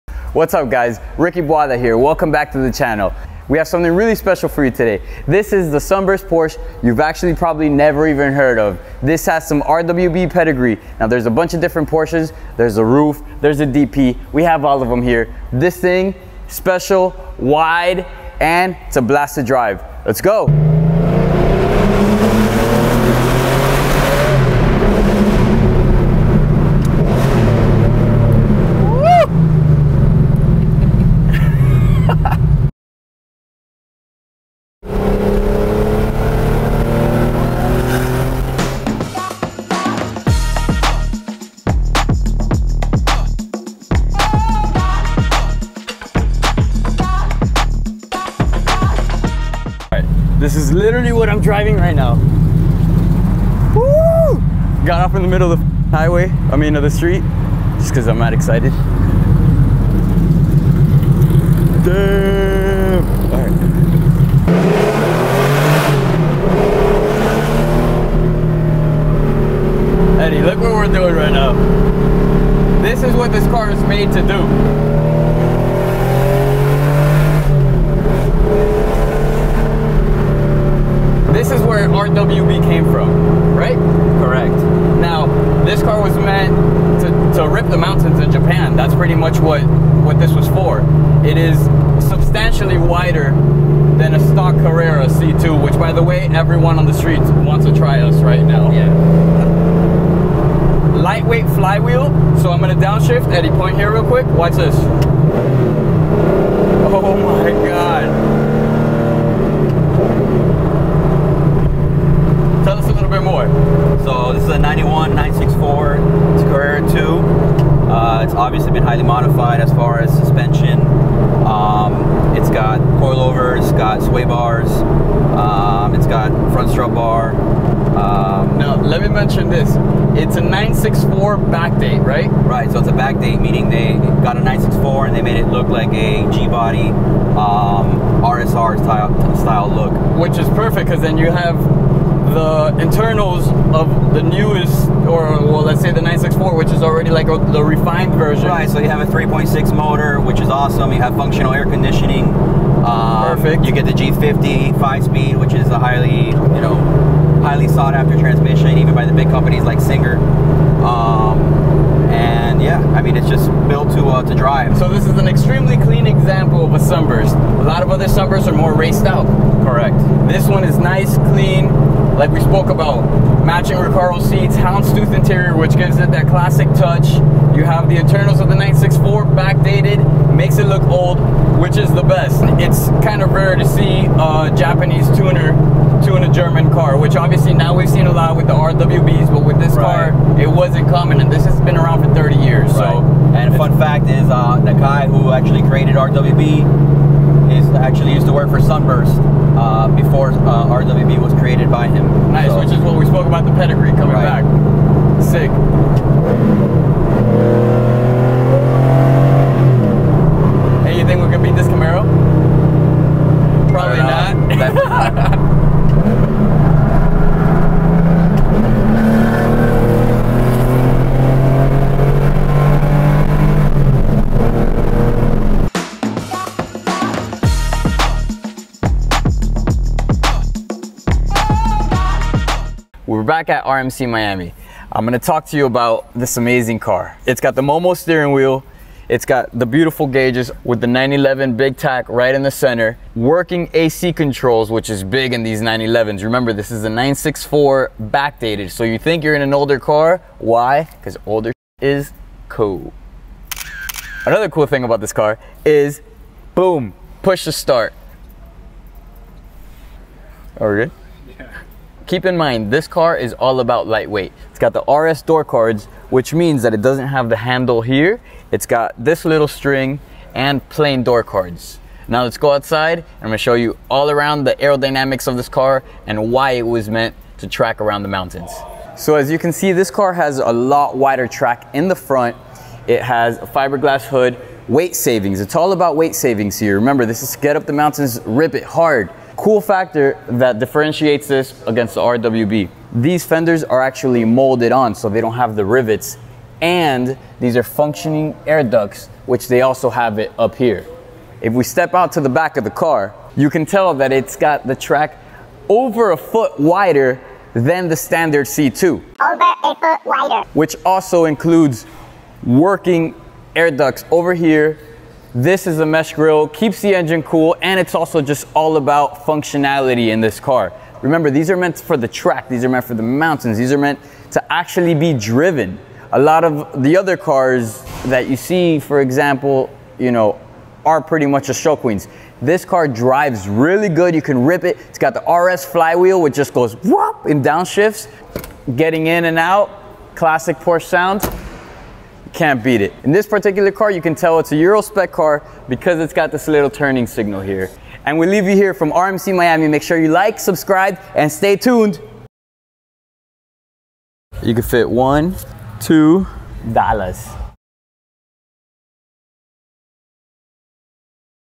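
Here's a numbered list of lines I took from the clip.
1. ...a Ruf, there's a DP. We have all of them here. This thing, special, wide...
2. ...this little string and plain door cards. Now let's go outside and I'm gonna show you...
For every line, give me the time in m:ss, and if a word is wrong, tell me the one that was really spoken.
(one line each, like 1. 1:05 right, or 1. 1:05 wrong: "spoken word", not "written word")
1. 0:12 right
2. 4:29 right.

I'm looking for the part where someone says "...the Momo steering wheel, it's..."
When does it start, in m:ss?
3:57.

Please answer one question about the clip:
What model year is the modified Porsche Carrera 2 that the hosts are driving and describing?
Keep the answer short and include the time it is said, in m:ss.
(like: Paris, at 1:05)
91, at 1:54.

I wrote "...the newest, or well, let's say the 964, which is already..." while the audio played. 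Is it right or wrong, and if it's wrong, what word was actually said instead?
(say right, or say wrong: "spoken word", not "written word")
right.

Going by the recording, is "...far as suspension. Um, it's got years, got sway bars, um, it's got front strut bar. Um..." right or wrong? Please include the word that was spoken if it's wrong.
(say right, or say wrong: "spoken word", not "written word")
wrong: "coilovers", not "years".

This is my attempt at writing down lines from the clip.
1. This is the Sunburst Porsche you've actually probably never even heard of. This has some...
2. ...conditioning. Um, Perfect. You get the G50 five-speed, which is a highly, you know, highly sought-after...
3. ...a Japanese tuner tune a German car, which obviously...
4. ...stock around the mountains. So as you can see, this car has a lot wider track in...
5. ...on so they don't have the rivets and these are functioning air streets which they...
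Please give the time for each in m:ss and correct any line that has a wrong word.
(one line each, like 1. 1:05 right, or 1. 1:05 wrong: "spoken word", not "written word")
1. 0:05 right
2. 2:31 right
3. 3:04 right
4. 4:37 wrong: "track", not "stock"
5. 4:54 wrong: "ducts", not "streets".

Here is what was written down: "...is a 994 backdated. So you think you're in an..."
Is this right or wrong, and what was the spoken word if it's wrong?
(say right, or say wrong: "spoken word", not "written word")
wrong: "964", not "994".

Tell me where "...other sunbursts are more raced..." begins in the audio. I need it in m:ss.
2:47.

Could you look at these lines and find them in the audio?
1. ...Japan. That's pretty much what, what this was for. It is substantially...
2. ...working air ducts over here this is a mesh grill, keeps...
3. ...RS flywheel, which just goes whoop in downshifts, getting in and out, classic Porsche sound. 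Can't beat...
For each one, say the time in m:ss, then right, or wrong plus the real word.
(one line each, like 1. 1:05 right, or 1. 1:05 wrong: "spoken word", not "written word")
1. 1:28 right
2. 5:12 right
3. 5:35 right.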